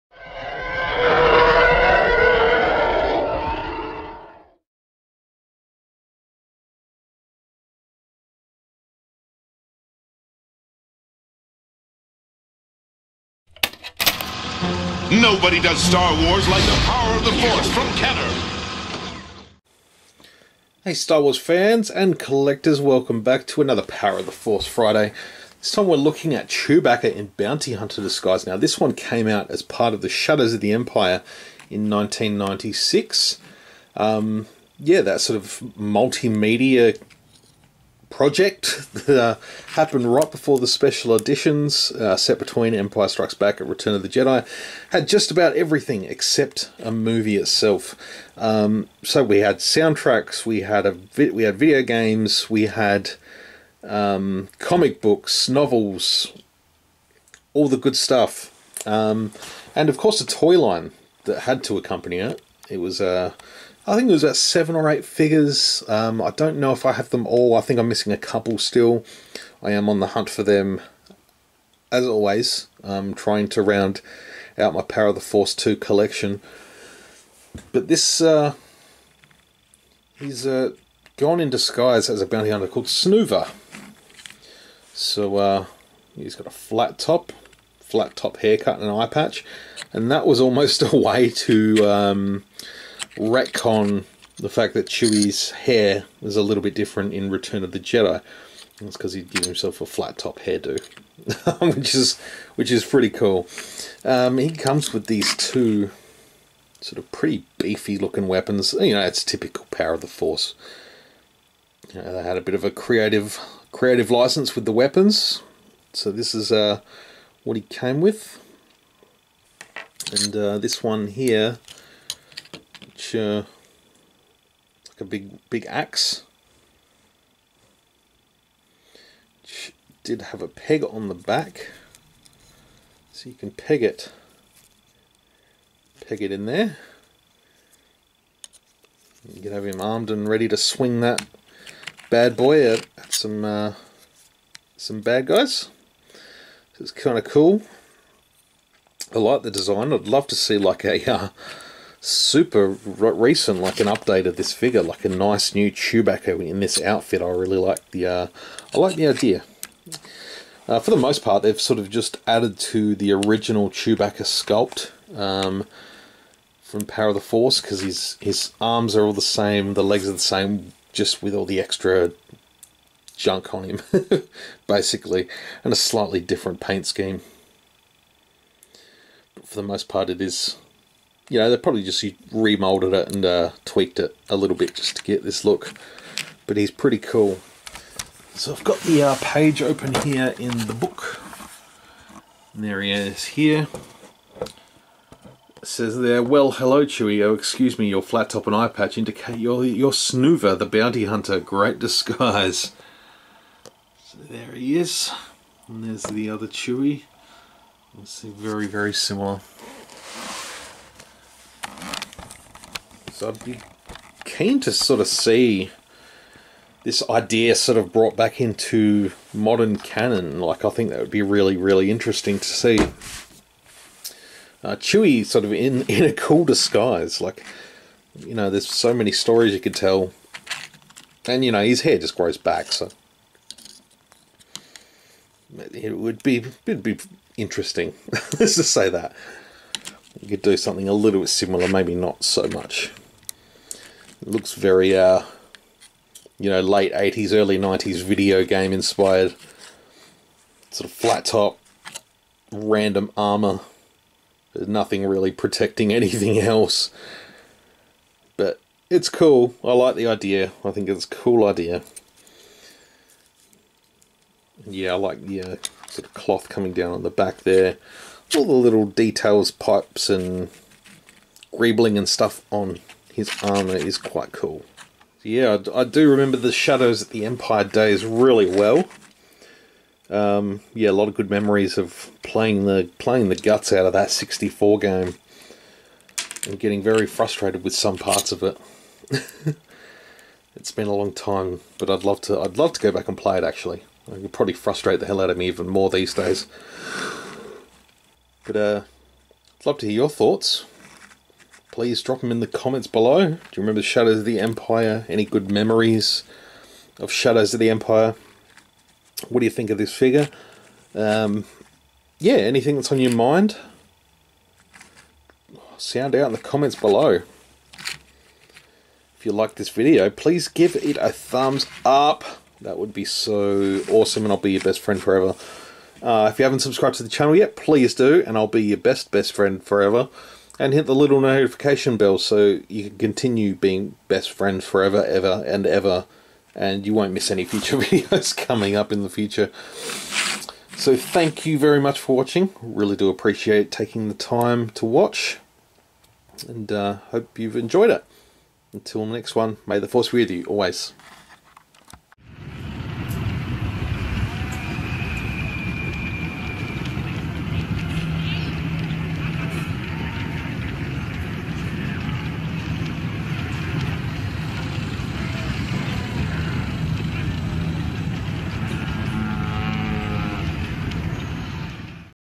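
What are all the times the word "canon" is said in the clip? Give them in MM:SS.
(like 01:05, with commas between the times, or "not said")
03:39.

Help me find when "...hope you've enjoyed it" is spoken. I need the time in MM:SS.
05:47.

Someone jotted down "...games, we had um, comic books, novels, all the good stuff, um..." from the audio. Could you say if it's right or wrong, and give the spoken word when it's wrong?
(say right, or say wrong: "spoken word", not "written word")
right.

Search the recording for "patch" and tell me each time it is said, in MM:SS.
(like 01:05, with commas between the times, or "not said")
01:29, 03:18.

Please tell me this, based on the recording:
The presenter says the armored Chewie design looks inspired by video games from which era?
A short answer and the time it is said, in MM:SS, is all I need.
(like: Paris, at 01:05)
Late 80s, early 90s, at 04:06.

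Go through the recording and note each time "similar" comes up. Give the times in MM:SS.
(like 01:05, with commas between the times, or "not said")
03:28, 04:01.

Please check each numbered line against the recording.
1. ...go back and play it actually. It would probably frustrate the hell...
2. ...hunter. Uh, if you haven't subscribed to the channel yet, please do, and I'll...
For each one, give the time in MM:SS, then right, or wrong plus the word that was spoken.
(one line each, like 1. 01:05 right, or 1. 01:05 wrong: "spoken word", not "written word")
1. 04:52 right
2. 05:25 wrong: "forever", not "hunter".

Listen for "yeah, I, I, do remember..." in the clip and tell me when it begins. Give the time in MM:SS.
04:35.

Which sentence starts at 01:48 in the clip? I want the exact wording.
You know, it's typical power of the Force.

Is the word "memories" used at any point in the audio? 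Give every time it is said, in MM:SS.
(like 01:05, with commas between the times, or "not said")
04:41, 05:05.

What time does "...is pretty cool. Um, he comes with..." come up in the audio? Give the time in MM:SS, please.
01:42.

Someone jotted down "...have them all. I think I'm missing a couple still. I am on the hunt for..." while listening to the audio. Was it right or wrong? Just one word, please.
right.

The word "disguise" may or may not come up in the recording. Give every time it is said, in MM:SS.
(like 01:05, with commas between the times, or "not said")
00:28, 01:21, 03:21, 03:46.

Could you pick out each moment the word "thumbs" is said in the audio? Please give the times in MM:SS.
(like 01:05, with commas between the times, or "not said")
05:21.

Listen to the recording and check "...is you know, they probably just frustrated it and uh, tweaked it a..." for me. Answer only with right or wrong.
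wrong.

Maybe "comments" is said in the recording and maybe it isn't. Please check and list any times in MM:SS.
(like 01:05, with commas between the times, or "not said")
05:02, 05:16.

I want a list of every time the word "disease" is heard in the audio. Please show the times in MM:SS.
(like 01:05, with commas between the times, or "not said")
not said.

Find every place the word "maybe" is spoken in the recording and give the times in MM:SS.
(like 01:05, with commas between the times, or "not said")
04:01.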